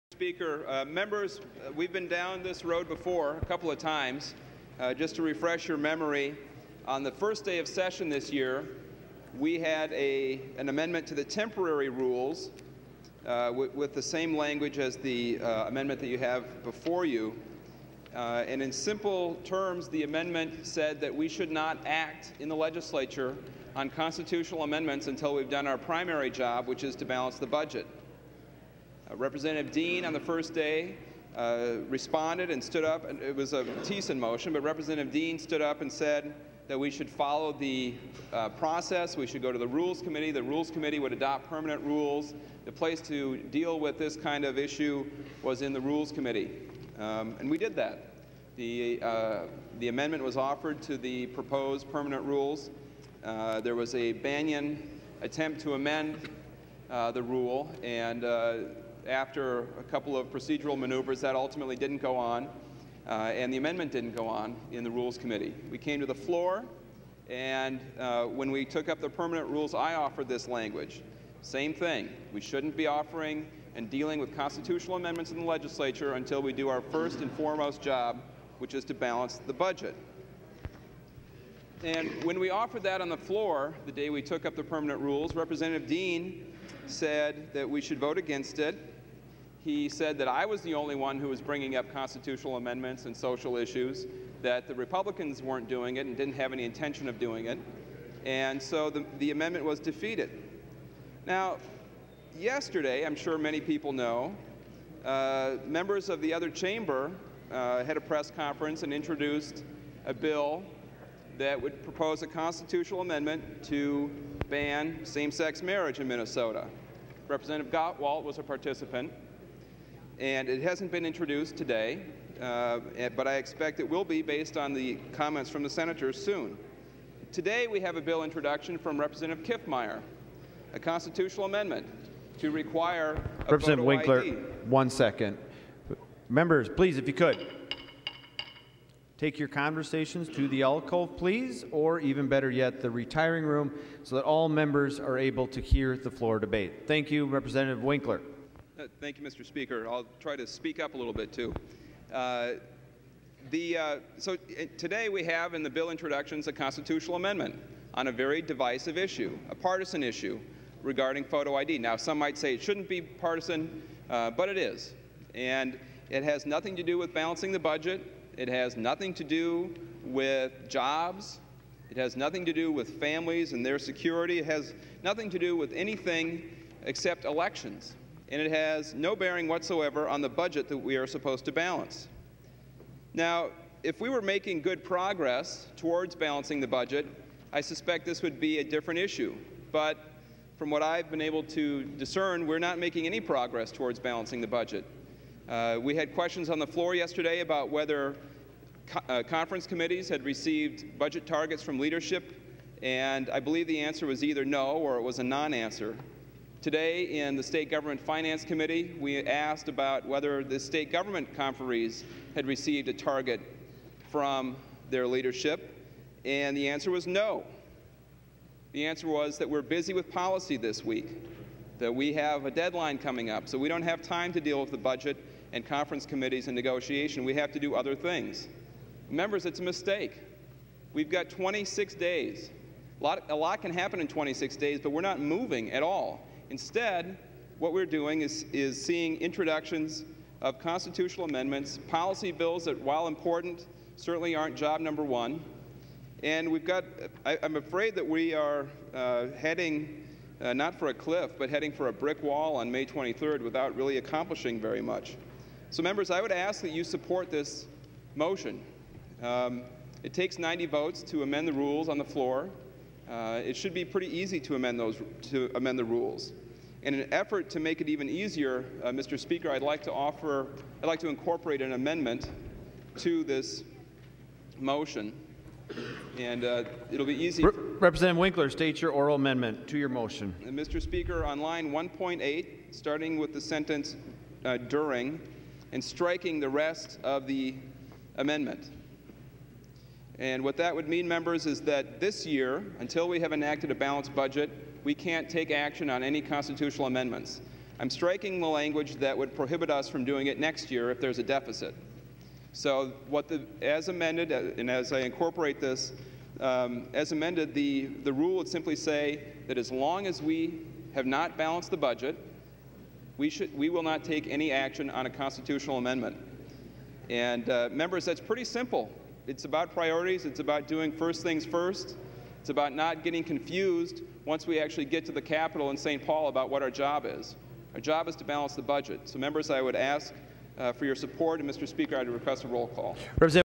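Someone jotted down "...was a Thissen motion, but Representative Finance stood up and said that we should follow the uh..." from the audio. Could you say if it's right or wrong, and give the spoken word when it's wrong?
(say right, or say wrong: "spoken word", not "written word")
wrong: "Dean", not "Finance".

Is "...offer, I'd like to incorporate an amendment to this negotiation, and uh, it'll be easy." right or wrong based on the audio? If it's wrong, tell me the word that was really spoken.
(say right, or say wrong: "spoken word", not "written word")
wrong: "motion", not "negotiation".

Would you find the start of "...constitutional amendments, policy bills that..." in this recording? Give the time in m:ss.
4:00.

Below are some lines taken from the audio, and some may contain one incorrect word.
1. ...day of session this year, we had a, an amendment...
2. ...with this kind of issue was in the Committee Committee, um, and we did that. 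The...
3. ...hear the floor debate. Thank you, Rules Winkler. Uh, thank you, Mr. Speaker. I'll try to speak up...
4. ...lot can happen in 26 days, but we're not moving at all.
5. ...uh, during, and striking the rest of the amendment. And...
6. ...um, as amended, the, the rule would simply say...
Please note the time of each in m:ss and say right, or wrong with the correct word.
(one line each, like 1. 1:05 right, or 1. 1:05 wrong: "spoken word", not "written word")
1. 0:07 right
2. 0:43 wrong: "Rules", not "Committee"
3. 2:25 wrong: "Representative", not "Rules"
4. 3:53 right
5. 4:44 right
6. 5:06 right.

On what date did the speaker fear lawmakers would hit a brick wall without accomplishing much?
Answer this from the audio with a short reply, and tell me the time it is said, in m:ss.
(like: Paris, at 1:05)
May 23, at 4:12.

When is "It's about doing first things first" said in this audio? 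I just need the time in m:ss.
5:20.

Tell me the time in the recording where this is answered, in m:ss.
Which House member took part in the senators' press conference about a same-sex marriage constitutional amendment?
1:57.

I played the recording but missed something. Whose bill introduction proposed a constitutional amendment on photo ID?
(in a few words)
Representative Kiffmeyer.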